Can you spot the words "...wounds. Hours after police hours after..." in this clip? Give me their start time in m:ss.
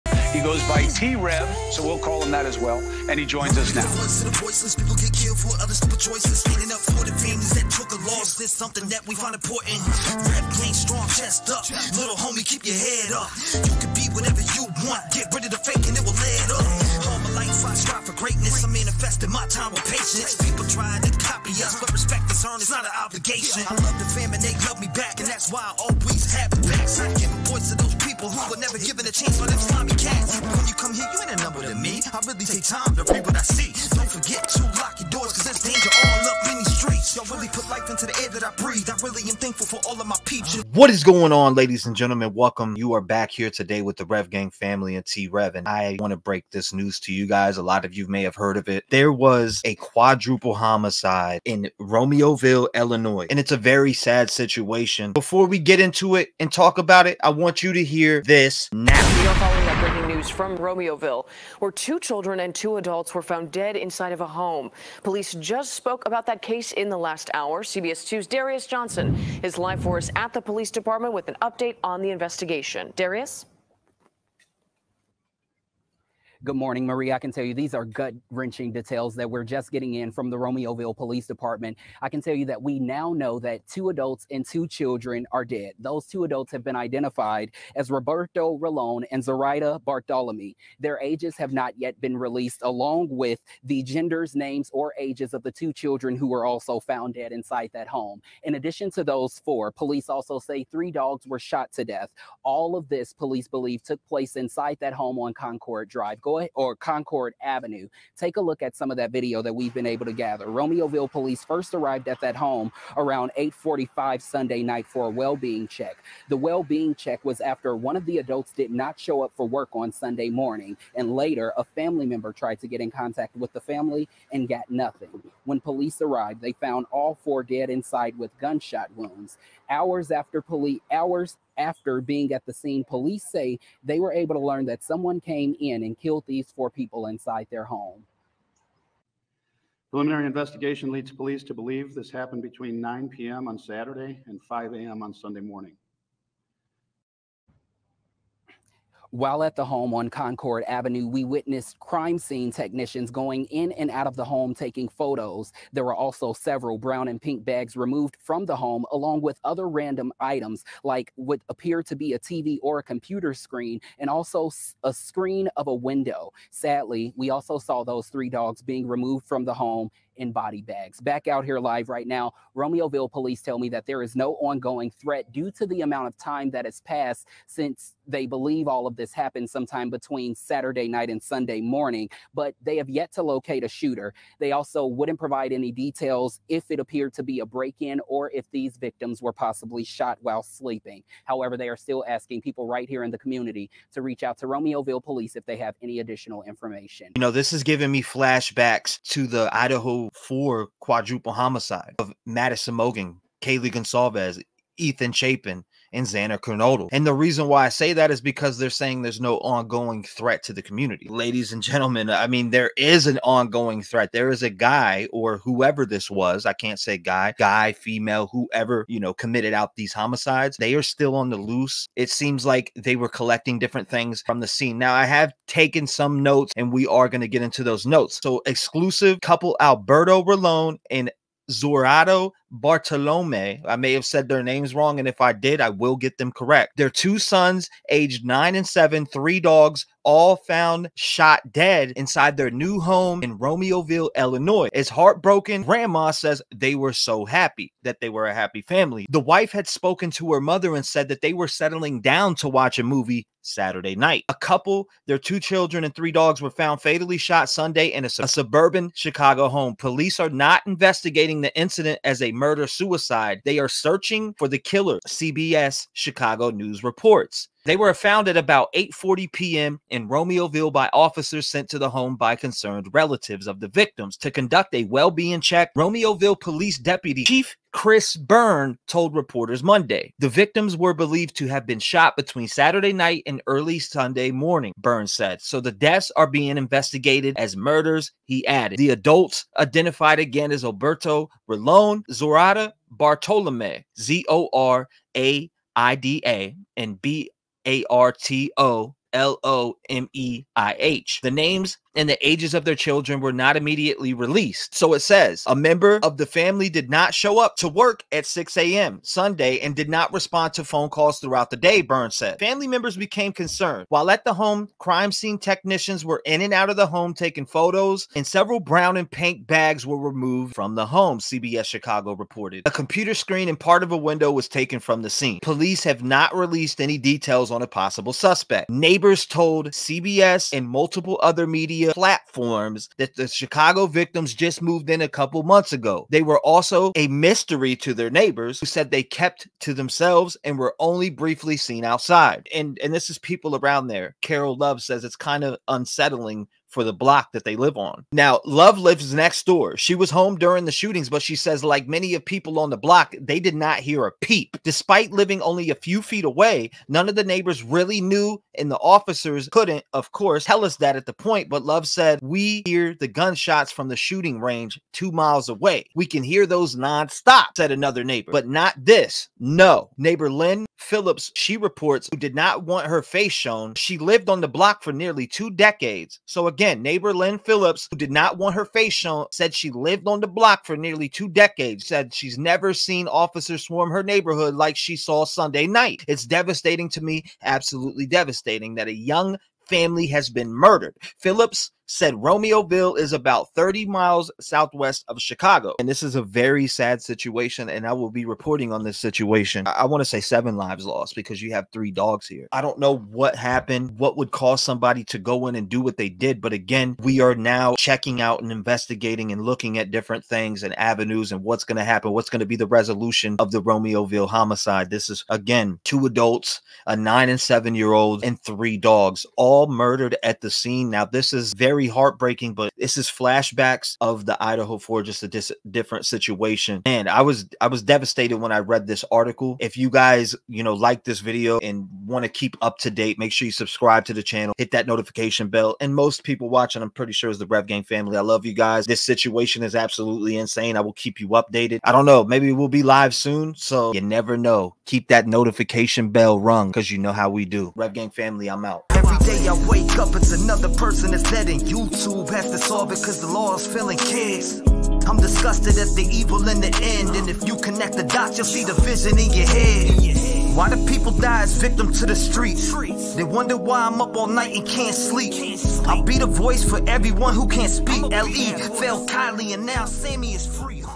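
2:08.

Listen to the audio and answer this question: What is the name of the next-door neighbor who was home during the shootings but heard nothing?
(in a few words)
Carol Love.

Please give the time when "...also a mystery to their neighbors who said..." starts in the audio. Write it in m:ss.
5:36.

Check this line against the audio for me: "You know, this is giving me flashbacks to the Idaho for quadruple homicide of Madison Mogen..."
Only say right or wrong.
right.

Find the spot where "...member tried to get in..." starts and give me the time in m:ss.
2:02.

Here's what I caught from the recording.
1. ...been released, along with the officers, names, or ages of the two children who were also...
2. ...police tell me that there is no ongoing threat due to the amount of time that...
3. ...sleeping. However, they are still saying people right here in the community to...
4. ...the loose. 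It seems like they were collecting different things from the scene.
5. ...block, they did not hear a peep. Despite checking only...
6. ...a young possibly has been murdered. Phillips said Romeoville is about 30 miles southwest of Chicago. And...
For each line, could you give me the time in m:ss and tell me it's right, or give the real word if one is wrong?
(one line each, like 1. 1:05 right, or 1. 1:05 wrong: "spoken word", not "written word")
1. 1:32 wrong: "genders", not "officers"
2. 2:53 right
3. 3:10 wrong: "asking", not "saying"
4. 3:41 right
5. 5:52 wrong: "living", not "checking"
6. 6:28 wrong: "family", not "possibly".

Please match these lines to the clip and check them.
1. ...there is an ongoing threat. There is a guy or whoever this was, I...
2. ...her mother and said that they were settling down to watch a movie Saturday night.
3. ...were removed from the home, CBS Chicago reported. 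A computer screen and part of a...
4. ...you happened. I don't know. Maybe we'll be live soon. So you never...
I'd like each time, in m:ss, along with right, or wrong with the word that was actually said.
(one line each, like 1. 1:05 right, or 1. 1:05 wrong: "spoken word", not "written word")
1. 3:32 right
2. 4:10 right
3. 5:19 right
4. 7:21 wrong: "updated", not "happened".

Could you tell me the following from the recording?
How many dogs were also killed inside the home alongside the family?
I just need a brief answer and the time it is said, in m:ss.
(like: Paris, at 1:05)
3, at 1:40.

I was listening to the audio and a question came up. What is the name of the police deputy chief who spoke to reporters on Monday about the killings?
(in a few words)
Chris Byrne.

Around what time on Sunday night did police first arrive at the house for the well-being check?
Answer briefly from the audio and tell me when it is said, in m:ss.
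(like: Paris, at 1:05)
8:45, at 1:53.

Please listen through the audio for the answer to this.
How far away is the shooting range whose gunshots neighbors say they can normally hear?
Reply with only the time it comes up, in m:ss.
6:04.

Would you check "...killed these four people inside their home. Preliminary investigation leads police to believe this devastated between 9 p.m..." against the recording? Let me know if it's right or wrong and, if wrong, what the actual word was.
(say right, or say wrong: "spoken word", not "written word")
wrong: "happened", not "devastated".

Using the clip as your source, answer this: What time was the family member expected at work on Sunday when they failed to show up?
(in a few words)
6 a.m.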